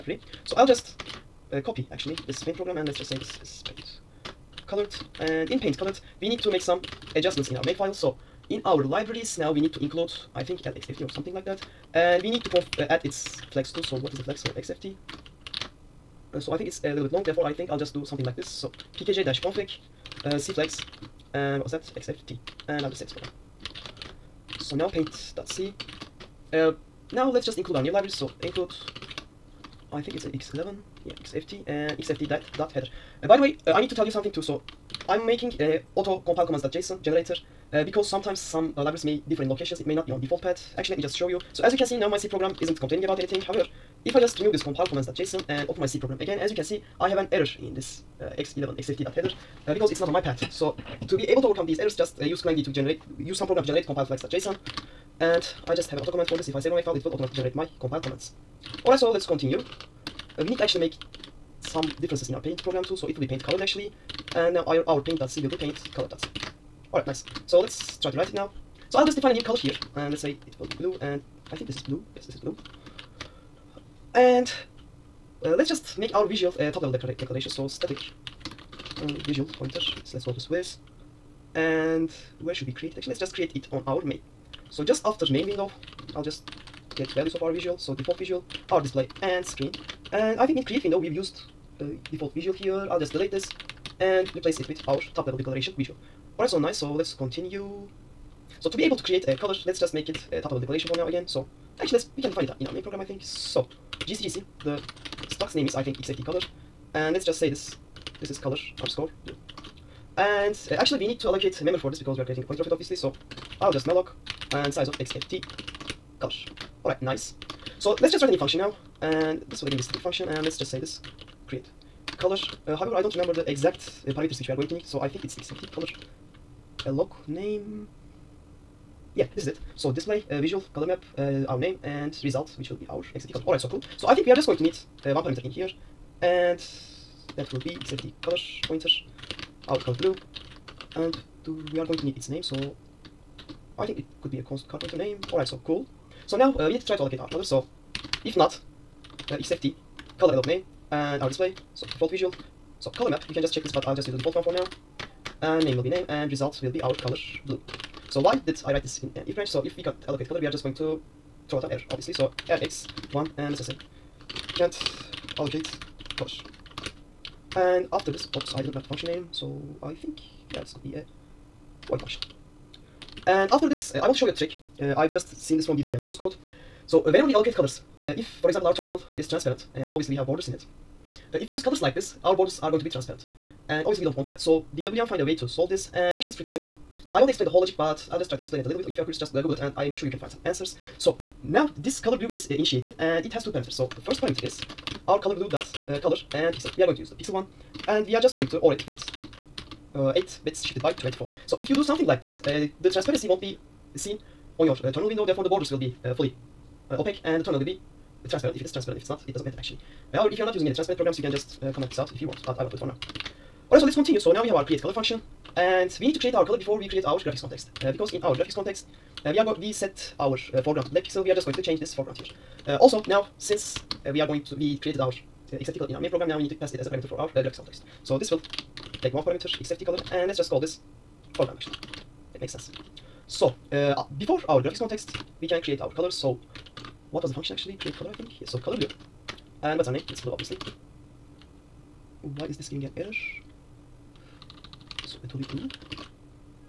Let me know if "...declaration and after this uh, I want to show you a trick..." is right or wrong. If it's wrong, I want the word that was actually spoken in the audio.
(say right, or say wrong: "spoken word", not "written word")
wrong: "function", not "declaration".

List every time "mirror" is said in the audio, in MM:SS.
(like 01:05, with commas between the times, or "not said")
not said.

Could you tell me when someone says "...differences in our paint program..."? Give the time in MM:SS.
01:02.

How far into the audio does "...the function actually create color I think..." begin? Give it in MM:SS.
03:57.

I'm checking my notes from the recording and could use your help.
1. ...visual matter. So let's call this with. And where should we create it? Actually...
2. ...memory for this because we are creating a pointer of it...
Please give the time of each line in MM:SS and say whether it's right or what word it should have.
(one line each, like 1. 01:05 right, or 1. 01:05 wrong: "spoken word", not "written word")
1. 01:19 wrong: "pointer", not "matter"
2. 01:51 right.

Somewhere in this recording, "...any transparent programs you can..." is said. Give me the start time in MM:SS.
03:30.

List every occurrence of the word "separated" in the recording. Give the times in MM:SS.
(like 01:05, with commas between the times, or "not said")
not said.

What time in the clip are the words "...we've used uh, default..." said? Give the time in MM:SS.
01:30.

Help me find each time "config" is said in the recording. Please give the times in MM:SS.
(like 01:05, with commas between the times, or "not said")
00:18.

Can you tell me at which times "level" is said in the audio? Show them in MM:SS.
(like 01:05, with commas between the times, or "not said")
01:16, 01:35, 01:40.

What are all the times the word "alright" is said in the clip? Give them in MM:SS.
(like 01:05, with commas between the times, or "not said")
00:58, 01:06, 01:36, 01:56, 03:33.